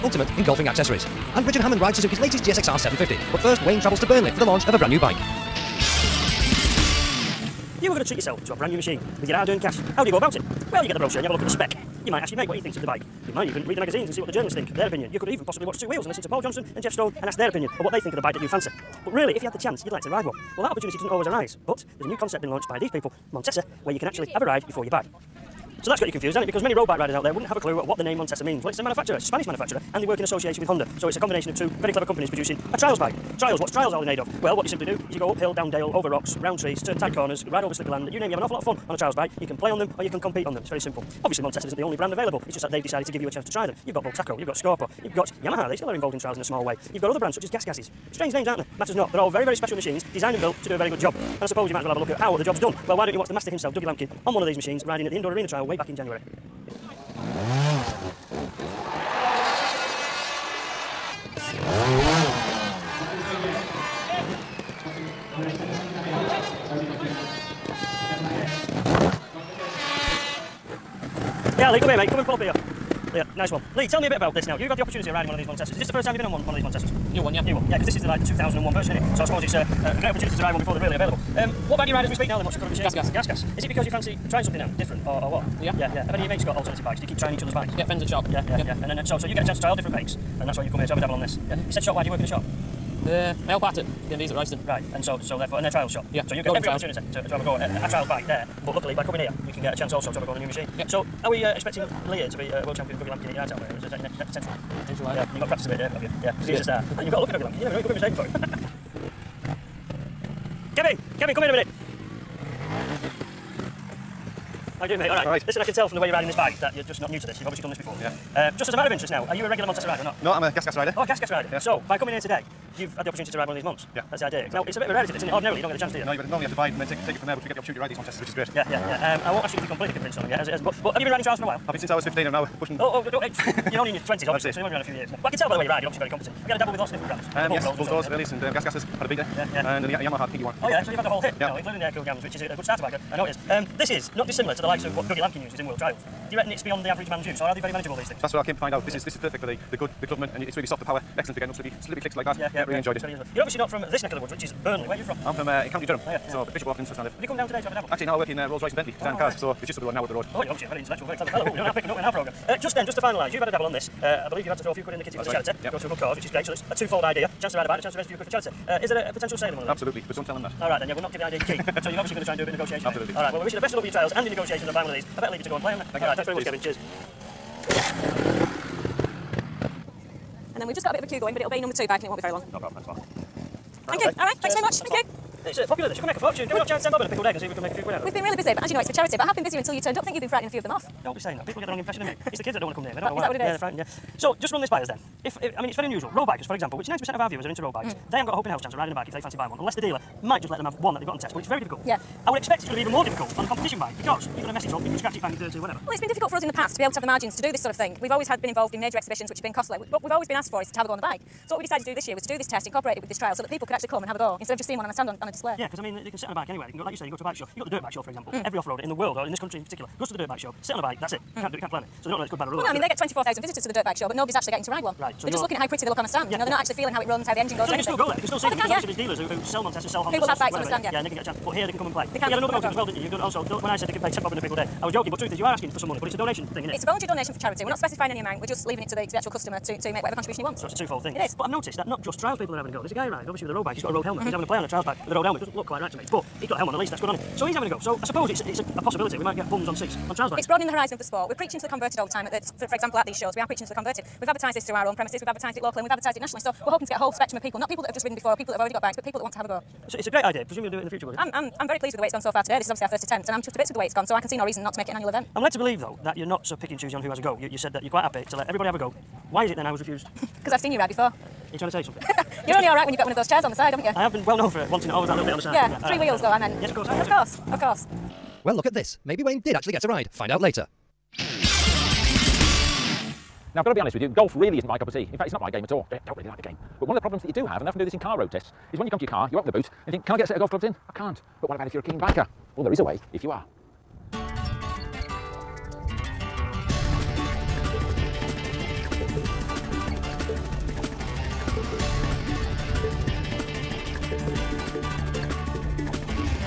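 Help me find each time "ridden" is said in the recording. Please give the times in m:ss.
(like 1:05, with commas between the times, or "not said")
4:18.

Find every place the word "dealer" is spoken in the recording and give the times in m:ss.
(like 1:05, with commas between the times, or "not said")
3:19, 3:48.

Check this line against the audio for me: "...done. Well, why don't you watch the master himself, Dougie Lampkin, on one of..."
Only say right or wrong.
right.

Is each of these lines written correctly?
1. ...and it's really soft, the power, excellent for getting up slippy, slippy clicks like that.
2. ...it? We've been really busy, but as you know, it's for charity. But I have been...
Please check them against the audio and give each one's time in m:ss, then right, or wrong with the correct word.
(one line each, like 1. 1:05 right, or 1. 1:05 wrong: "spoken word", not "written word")
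1. 2:30 right
2. 3:08 right.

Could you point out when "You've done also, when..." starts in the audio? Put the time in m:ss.
3:53.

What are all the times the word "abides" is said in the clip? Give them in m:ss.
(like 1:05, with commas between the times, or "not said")
not said.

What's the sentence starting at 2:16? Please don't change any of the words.
Have you had a dabble with lots of different brands?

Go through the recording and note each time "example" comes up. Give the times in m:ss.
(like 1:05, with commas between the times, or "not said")
3:16, 3:38, 4:12.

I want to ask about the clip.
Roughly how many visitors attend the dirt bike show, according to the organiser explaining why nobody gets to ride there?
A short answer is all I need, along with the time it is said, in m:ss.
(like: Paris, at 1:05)
24,000, at 3:42.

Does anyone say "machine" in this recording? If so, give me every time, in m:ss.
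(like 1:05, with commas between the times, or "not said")
0:08, 0:49, 0:54, 1:22, 1:40.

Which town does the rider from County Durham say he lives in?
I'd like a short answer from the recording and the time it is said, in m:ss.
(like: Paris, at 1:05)
Bishop Auckland, at 2:36.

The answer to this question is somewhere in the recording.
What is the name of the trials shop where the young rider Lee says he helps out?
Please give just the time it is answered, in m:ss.
1:34.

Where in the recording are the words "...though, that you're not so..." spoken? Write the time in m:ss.
4:25.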